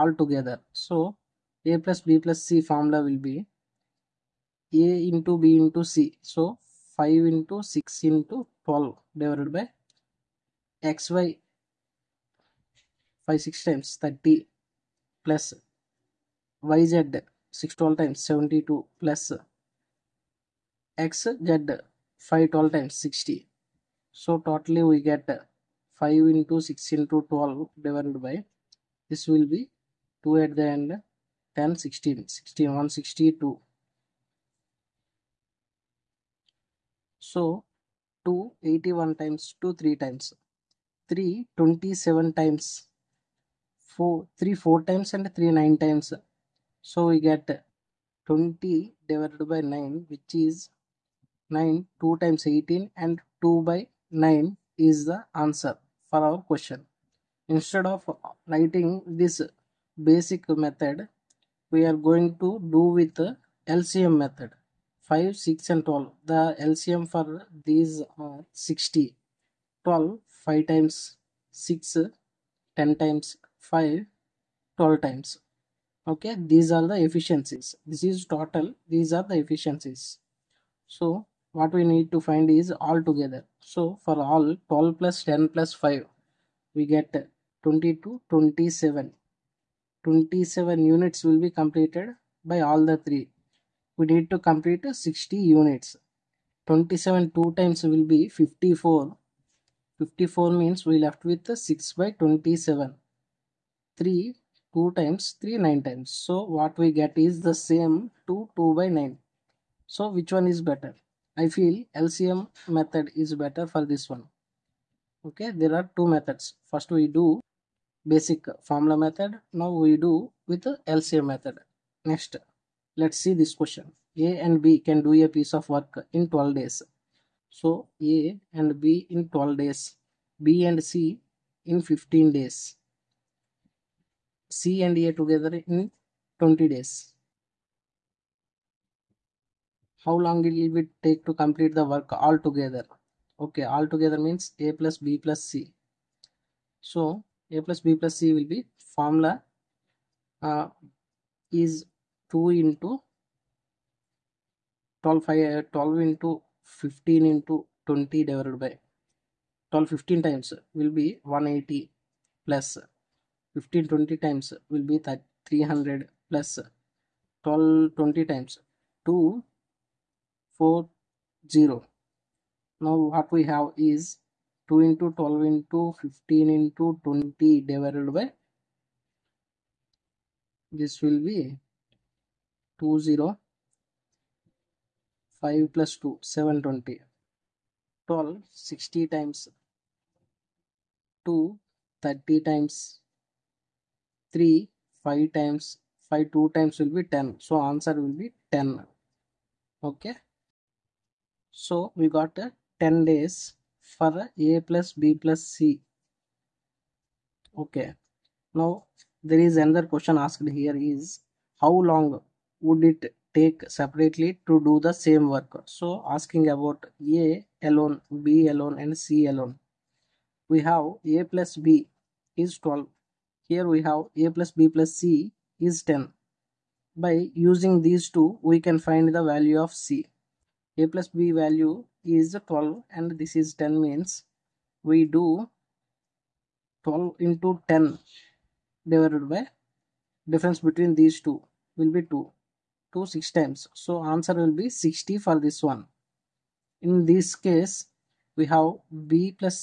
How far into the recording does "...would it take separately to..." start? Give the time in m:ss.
3:32.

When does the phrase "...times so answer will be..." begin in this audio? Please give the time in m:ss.
4:03.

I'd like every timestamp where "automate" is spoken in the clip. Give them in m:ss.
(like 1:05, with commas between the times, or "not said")
not said.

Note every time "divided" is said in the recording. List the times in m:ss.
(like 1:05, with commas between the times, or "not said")
0:09, 2:38, 2:57, 3:58.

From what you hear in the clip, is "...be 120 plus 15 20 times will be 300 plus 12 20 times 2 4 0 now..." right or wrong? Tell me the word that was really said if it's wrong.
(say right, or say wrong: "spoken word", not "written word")
wrong: "180", not "120".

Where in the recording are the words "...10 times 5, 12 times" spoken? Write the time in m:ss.
1:12.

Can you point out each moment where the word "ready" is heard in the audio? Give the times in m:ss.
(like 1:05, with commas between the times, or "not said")
not said.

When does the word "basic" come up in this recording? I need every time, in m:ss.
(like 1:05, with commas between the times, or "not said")
1:00, 1:58.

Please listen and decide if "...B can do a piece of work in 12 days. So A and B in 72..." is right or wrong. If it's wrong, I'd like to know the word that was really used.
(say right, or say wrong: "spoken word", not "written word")
wrong: "12", not "72".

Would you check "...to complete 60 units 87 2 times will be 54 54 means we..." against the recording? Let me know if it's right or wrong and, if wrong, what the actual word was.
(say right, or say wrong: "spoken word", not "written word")
wrong: "27", not "87".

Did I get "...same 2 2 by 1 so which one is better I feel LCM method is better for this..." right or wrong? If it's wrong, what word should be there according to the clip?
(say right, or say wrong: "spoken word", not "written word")
wrong: "9", not "1".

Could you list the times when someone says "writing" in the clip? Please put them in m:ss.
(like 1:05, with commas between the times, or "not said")
0:58.